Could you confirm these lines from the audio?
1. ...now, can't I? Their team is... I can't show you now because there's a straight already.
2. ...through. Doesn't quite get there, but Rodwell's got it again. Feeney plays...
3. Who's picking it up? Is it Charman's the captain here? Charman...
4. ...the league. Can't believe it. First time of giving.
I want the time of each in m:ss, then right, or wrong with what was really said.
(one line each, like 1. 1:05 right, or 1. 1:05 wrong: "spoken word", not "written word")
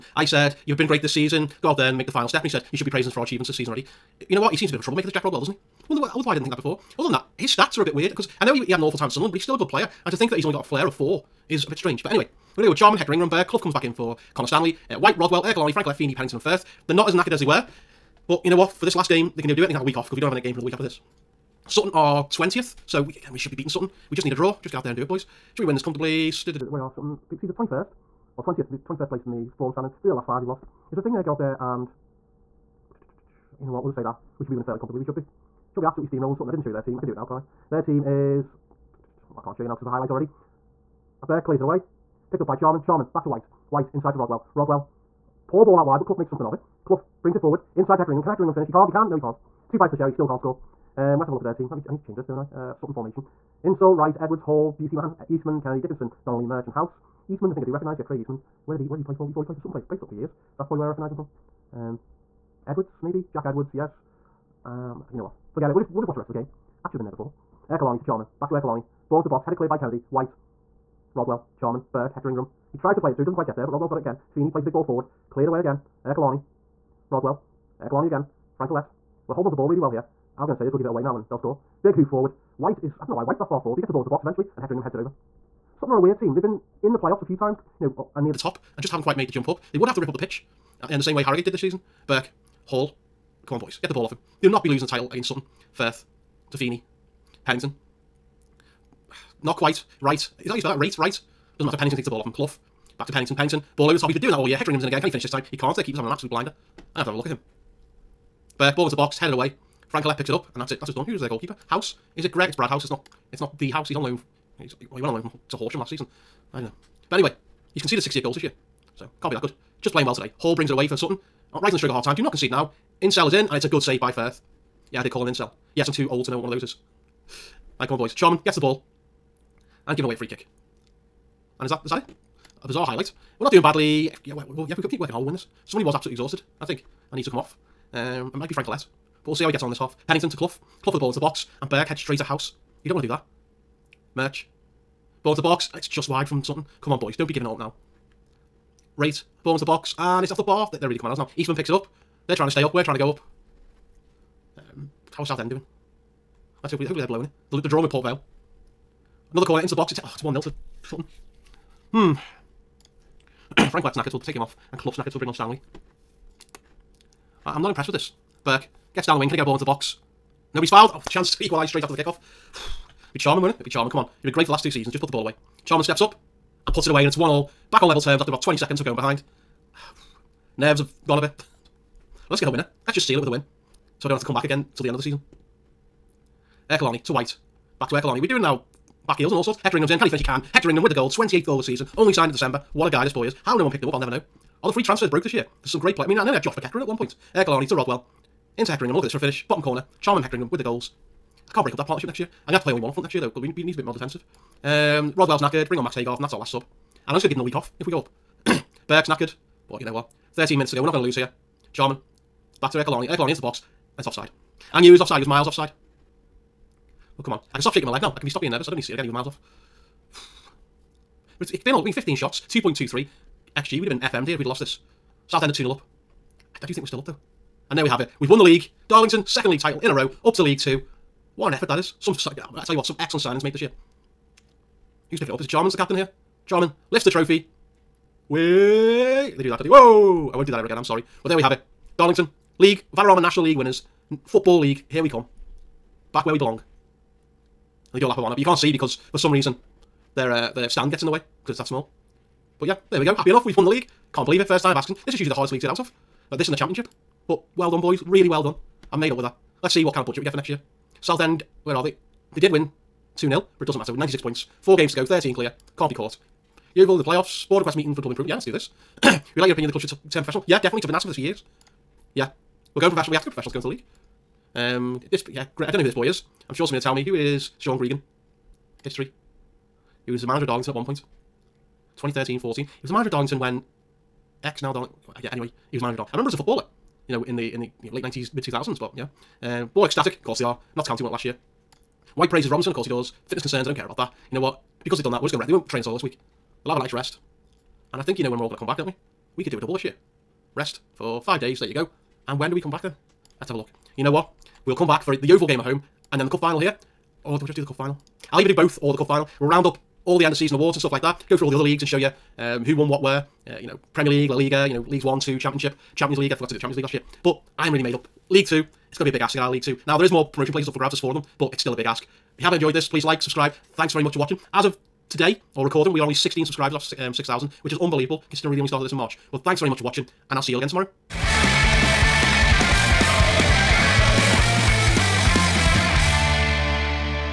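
1. 0:37 wrong: "highlight", not "straight"
2. 1:13 right
3. 3:55 right
4. 4:13 wrong: "asking", not "giving".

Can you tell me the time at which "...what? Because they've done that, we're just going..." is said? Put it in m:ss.
4:54.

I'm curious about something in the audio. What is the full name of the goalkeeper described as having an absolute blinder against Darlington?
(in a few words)
Brad House.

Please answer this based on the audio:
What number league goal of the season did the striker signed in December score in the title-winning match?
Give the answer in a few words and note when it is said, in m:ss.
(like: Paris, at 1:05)
28th, at 3:11.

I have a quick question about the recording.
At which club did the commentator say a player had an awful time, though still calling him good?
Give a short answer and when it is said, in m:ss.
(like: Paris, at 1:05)
Sunderland, at 0:09.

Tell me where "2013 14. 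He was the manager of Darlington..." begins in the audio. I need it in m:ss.
4:41.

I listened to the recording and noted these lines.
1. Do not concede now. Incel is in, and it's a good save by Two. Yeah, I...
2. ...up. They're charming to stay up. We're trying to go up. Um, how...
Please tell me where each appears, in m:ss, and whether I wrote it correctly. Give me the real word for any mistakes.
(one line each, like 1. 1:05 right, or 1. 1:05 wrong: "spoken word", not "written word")
1. 2:02 wrong: "Firth", not "Two"
2. 2:31 wrong: "trying", not "charming".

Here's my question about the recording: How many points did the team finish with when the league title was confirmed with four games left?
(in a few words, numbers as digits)
96.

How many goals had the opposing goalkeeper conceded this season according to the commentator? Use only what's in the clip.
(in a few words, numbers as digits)
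68.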